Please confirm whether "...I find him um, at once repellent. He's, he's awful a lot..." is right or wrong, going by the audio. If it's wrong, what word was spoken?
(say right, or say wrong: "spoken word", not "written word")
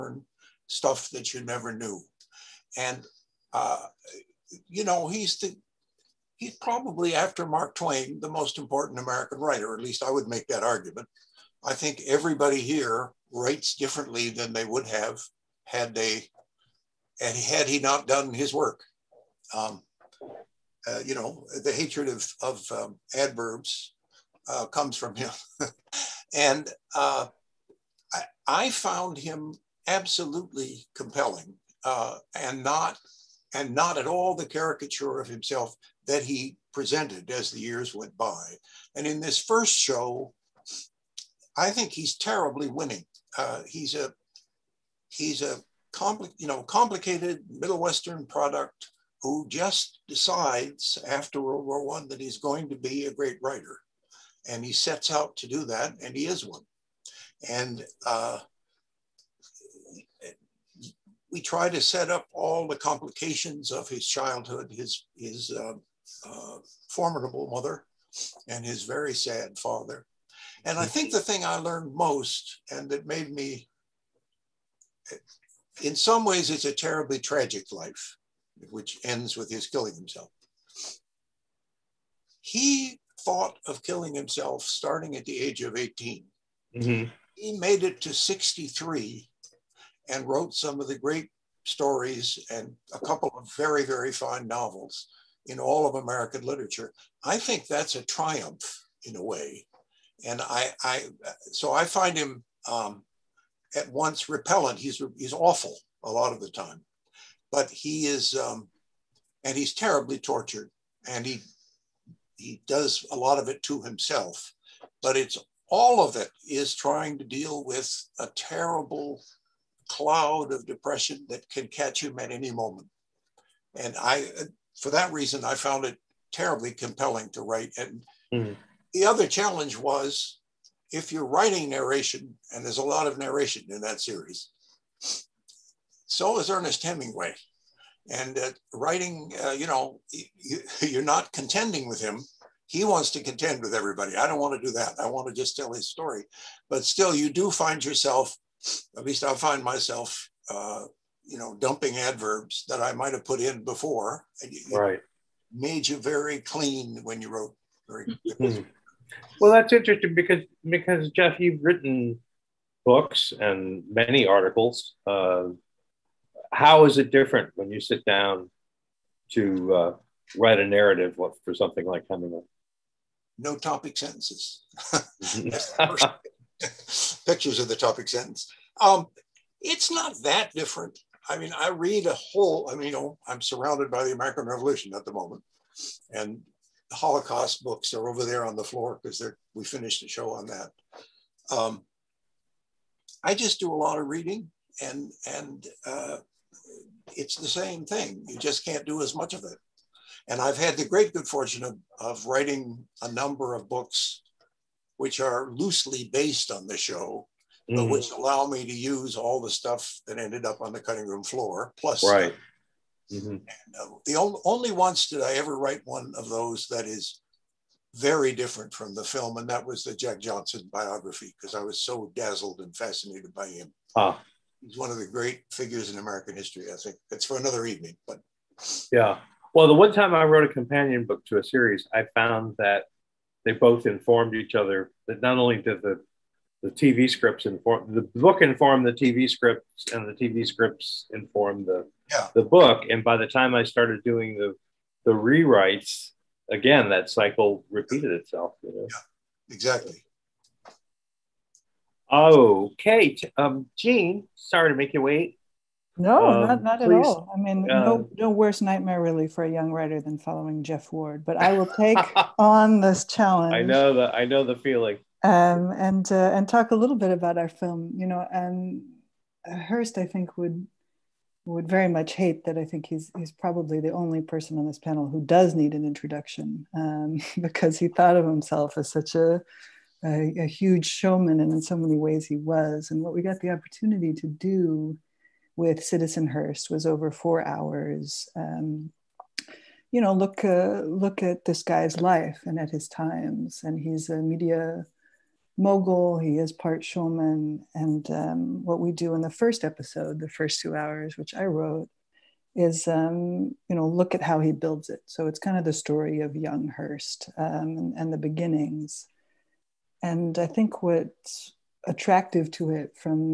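right.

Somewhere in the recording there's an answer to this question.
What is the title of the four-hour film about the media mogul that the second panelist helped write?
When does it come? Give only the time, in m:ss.
4:45.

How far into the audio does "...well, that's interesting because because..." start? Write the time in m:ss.
2:39.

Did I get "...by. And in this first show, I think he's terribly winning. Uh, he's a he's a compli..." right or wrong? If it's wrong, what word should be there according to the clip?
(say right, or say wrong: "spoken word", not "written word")
right.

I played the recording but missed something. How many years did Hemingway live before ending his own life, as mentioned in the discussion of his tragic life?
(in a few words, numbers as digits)
63.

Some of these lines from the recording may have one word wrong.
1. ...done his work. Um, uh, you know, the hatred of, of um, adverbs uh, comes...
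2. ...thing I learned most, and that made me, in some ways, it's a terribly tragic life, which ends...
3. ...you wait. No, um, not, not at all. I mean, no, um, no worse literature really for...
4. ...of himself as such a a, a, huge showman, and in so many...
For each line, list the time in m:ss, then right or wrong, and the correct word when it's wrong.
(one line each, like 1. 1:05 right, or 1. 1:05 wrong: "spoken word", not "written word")
1. 0:18 right
2. 1:11 right
3. 4:14 wrong: "nightmare", not "literature"
4. 4:38 right.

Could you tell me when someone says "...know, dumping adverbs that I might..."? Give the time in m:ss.
2:31.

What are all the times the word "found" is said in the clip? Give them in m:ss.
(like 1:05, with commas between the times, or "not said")
0:28, 2:05, 3:52.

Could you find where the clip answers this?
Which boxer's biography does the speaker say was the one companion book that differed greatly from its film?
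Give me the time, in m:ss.
3:39.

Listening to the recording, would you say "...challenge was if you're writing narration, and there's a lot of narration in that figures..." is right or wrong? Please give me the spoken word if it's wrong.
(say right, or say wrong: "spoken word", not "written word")
wrong: "series", not "figures".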